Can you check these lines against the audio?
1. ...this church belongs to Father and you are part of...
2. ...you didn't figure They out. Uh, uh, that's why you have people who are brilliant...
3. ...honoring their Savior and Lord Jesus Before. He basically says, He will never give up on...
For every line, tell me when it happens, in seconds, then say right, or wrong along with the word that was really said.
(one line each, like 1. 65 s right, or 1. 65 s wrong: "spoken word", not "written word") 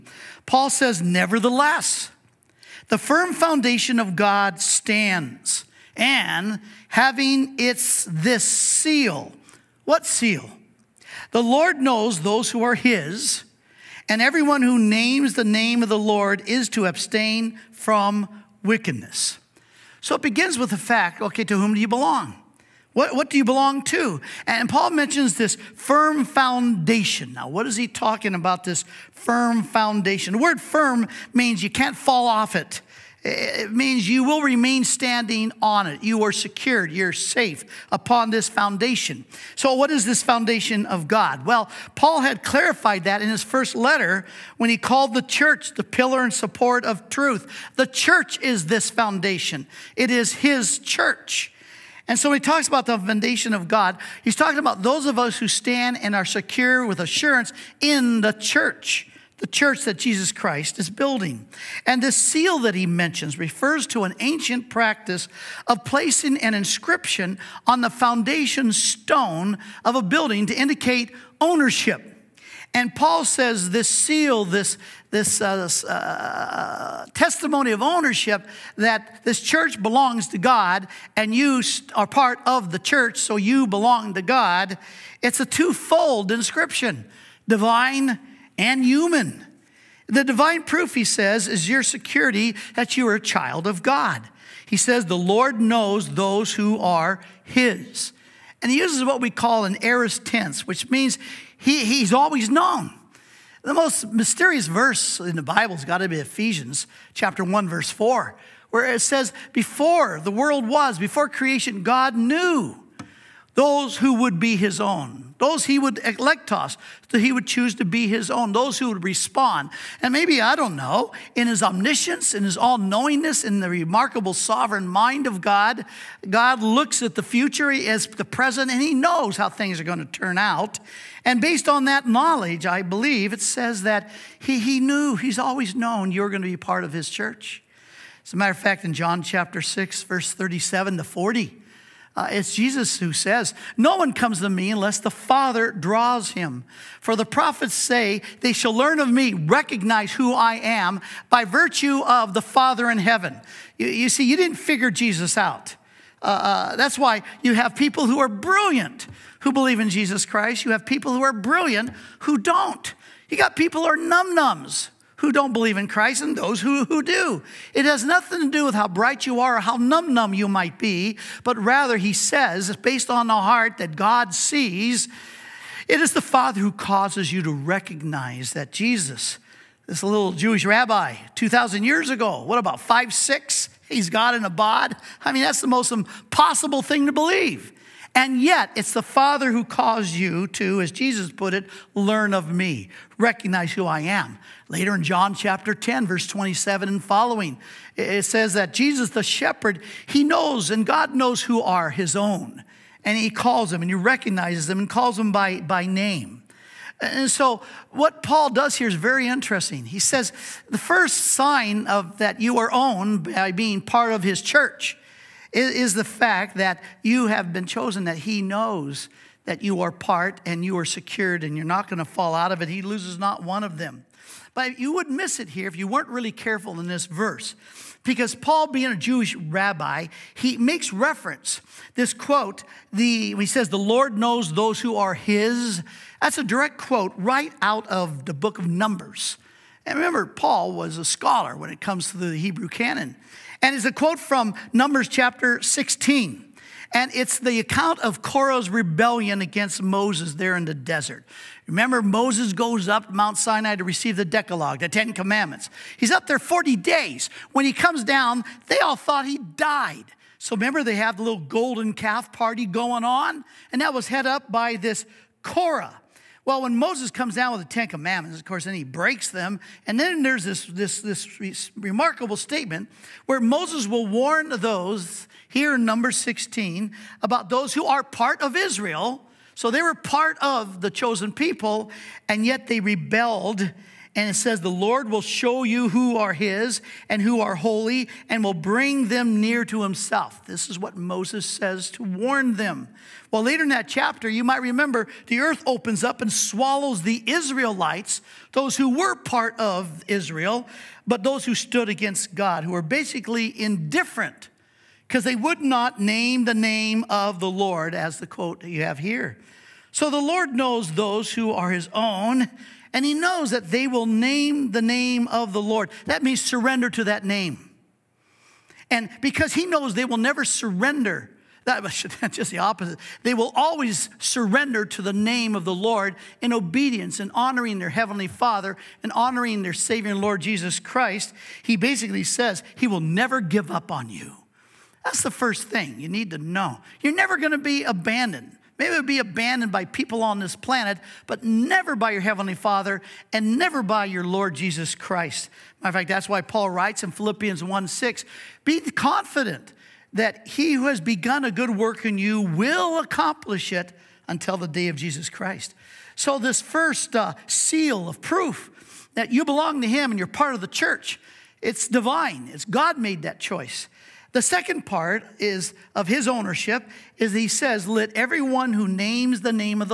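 1. 79 s wrong: "God", not "Father"
2. 154 s wrong: "Jesus", not "They"
3. 329 s wrong: "Christ", not "Before".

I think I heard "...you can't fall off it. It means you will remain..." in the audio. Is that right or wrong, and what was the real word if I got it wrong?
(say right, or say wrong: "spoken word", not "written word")
right.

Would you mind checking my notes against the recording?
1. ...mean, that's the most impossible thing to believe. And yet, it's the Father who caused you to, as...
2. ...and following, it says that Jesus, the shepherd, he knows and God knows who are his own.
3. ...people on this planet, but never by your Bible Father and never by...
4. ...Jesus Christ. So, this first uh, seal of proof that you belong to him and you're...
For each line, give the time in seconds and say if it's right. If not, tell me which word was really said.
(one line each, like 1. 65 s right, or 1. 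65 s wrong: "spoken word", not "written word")
1. 185 s right
2. 196 s right
3. 339 s wrong: "Heavenly", not "Bible"
4. 354 s right.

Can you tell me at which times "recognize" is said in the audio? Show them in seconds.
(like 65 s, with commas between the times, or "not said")
149 s, 177 s, 193 s, 203 s.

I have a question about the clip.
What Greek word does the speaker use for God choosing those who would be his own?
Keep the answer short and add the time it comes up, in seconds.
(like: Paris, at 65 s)
eklektos, at 115 s.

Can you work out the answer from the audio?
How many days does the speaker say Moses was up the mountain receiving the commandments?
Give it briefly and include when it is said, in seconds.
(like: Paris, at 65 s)
40, at 256 s.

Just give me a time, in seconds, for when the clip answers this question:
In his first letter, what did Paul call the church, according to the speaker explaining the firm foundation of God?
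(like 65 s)
45 s.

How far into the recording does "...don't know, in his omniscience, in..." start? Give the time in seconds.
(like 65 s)
120 s.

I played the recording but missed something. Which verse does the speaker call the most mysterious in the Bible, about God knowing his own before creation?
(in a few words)
Ephesians 1:4.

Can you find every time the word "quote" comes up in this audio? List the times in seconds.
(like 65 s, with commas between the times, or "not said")
232 s, 236 s, 243 s, 308 s.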